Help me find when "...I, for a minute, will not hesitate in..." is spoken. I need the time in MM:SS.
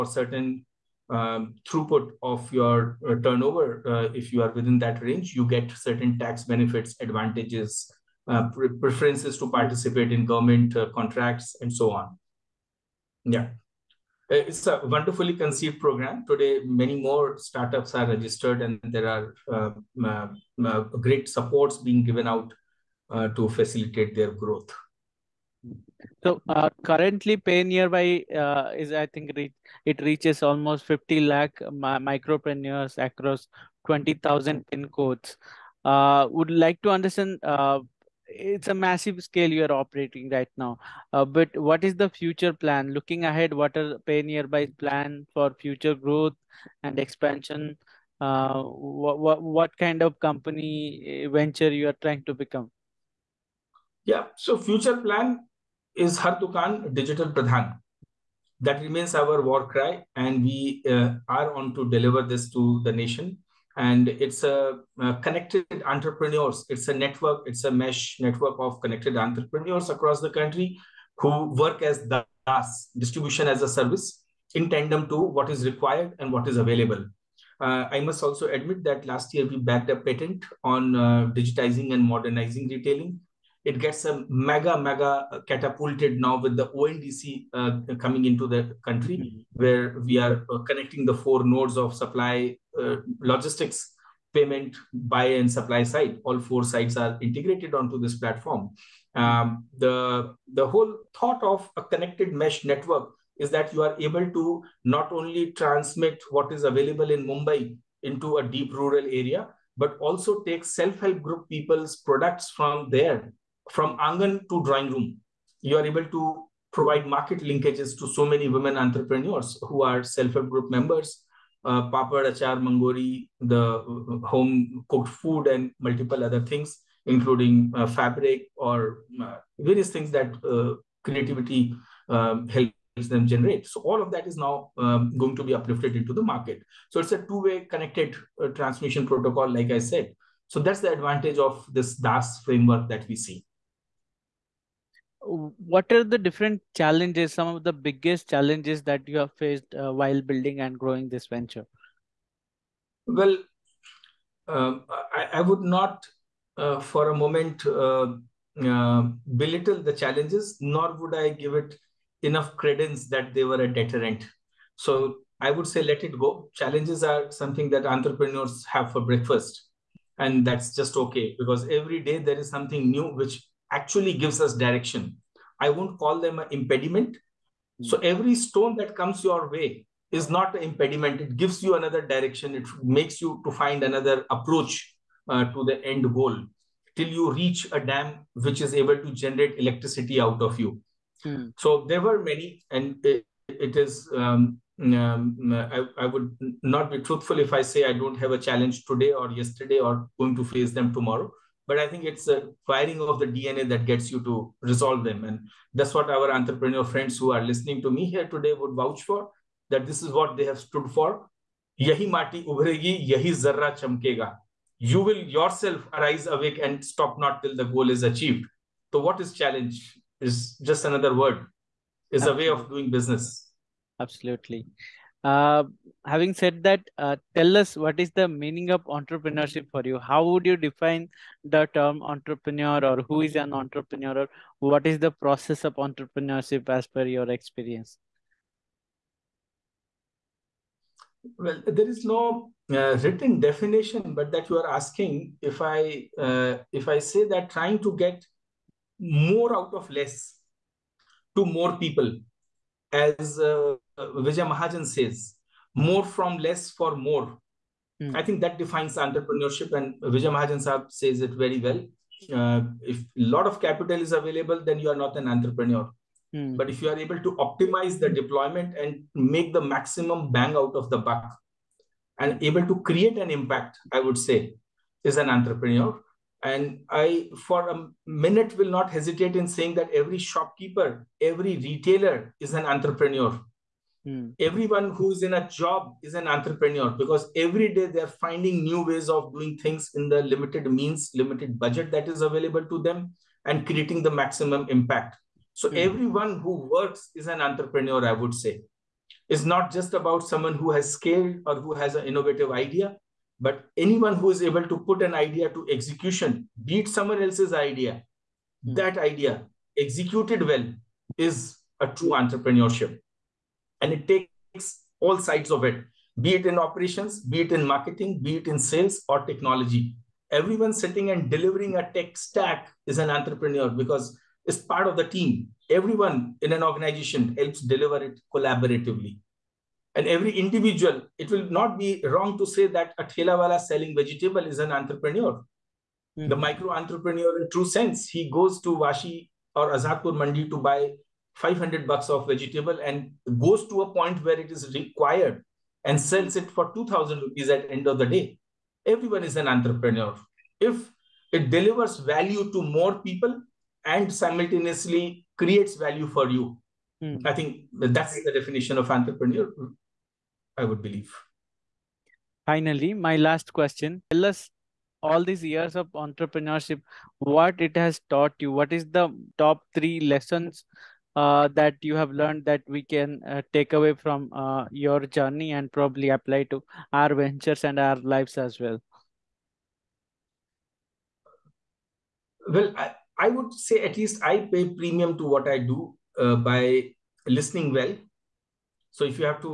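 04:36.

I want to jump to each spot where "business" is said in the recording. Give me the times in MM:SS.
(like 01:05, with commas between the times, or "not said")
03:42.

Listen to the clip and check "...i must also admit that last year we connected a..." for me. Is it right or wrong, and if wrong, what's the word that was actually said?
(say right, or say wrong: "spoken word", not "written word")
wrong: "backed", not "connected".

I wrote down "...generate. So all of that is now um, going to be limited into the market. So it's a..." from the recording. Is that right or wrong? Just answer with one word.
wrong.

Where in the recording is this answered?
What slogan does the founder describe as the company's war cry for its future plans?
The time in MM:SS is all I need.
00:56.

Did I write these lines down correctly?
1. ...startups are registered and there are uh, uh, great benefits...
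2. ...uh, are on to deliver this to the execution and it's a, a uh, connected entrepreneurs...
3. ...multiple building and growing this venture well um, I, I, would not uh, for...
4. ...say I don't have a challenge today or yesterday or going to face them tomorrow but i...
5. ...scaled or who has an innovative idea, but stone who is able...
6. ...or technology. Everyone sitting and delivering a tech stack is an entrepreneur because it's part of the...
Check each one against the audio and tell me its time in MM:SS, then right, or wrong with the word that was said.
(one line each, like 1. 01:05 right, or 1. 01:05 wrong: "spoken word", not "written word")
1. 00:17 wrong: "supports", not "benefits"
2. 01:00 wrong: "nation", not "execution"
3. 02:29 wrong: "while", not "multiple"
4. 03:17 right
5. 05:00 wrong: "anyone", not "stone"
6. 05:19 right.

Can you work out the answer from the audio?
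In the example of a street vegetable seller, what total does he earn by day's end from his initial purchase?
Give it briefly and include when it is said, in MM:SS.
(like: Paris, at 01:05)
2000 rupees, at 05:46.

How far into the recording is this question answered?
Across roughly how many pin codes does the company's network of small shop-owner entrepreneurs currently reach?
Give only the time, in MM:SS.
00:33.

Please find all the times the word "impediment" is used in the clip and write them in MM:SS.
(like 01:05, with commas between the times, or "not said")
02:56, 03:00.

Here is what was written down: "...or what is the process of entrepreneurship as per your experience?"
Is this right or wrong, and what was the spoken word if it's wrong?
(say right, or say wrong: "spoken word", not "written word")
right.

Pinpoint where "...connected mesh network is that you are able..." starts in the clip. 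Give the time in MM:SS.
01:41.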